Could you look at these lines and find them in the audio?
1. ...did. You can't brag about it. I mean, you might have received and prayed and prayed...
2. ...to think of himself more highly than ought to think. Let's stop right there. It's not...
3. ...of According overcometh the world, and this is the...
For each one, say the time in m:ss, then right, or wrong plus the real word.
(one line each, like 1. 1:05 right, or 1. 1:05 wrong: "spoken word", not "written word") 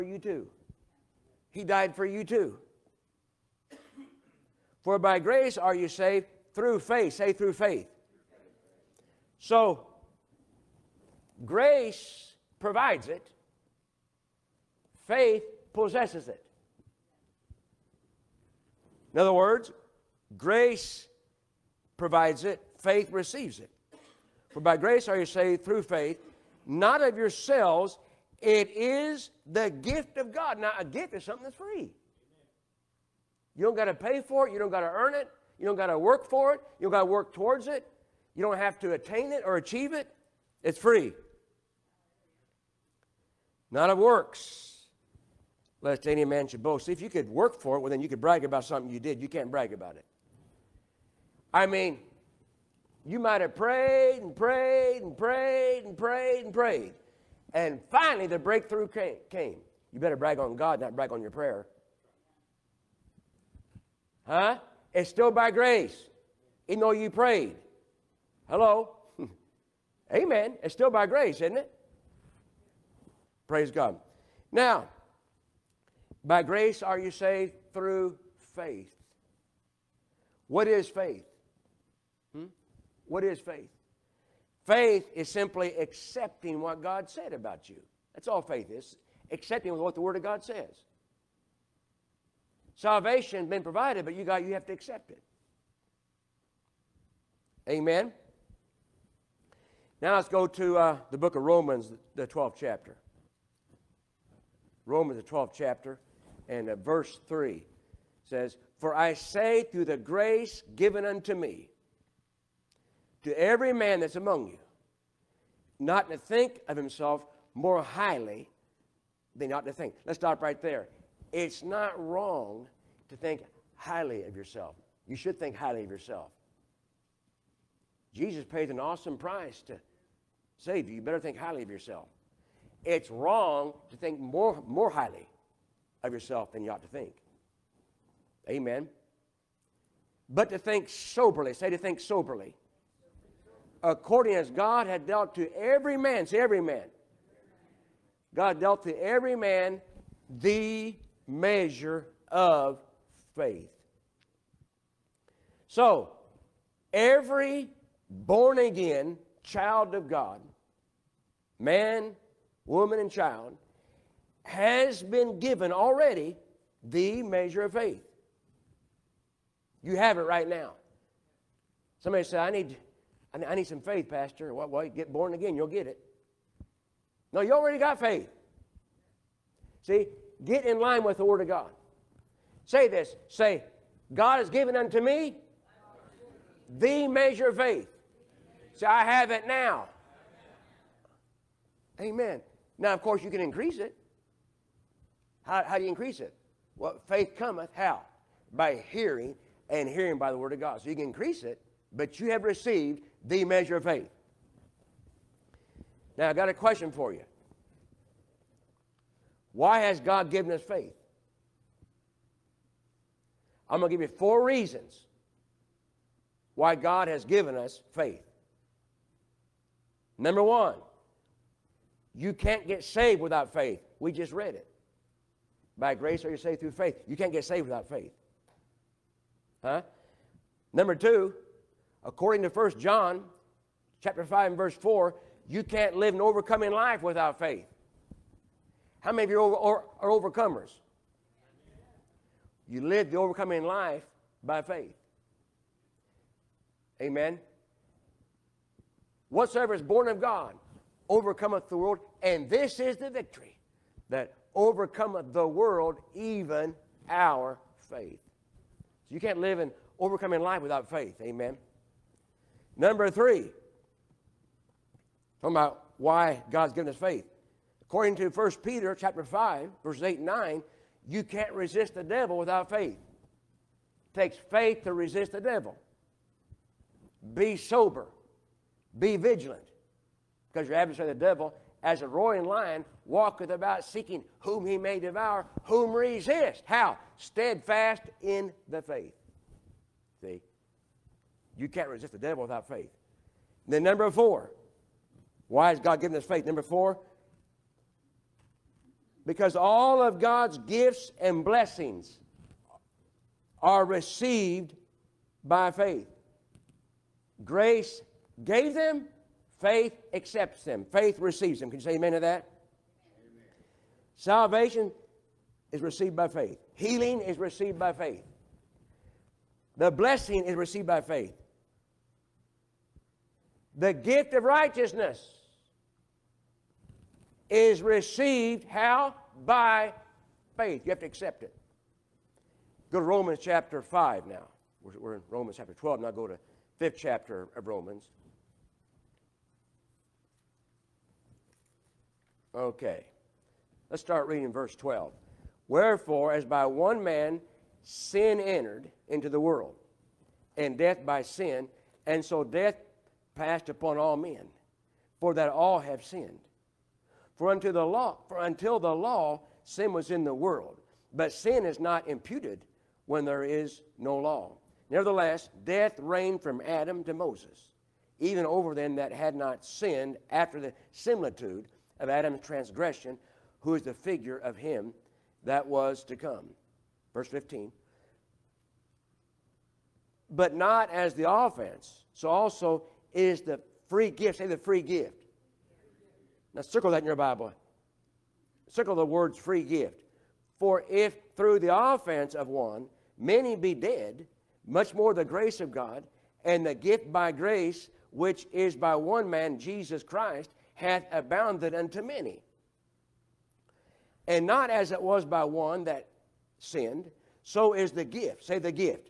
1. 0:48 wrong: "prayed", not "received"
2. 1:56 right
3. 4:10 wrong: "God", not "According".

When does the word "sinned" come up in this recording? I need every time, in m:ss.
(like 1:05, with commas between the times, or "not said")
5:56, 6:09, 6:46.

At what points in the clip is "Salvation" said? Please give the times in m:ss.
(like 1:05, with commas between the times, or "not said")
1:32, 5:14.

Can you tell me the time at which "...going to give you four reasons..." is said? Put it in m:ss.
3:33.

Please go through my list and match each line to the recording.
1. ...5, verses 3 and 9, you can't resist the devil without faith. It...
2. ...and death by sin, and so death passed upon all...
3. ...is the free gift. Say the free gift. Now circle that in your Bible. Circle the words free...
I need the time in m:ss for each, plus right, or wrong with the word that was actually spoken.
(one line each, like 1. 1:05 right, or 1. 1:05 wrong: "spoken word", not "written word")
1. 4:29 wrong: "8", not "3"
2. 5:50 right
3. 6:23 right.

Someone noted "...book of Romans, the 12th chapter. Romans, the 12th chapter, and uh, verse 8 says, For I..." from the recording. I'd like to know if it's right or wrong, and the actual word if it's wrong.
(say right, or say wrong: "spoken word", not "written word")
wrong: "3", not "8".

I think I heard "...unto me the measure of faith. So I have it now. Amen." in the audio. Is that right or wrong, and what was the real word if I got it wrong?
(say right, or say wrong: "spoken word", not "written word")
right.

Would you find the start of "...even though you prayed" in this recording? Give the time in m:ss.
1:06.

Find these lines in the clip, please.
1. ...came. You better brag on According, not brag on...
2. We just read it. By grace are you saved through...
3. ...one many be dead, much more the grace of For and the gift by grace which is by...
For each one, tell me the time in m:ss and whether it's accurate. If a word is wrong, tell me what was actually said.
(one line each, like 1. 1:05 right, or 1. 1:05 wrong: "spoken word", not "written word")
1. 0:58 wrong: "God", not "According"
2. 3:43 right
3. 6:32 wrong: "God", not "For".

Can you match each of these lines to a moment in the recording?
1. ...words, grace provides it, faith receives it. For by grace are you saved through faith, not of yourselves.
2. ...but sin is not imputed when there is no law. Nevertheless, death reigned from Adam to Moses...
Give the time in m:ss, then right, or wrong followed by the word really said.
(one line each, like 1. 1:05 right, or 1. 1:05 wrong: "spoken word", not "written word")
1. 0:19 right
2. 6:01 right.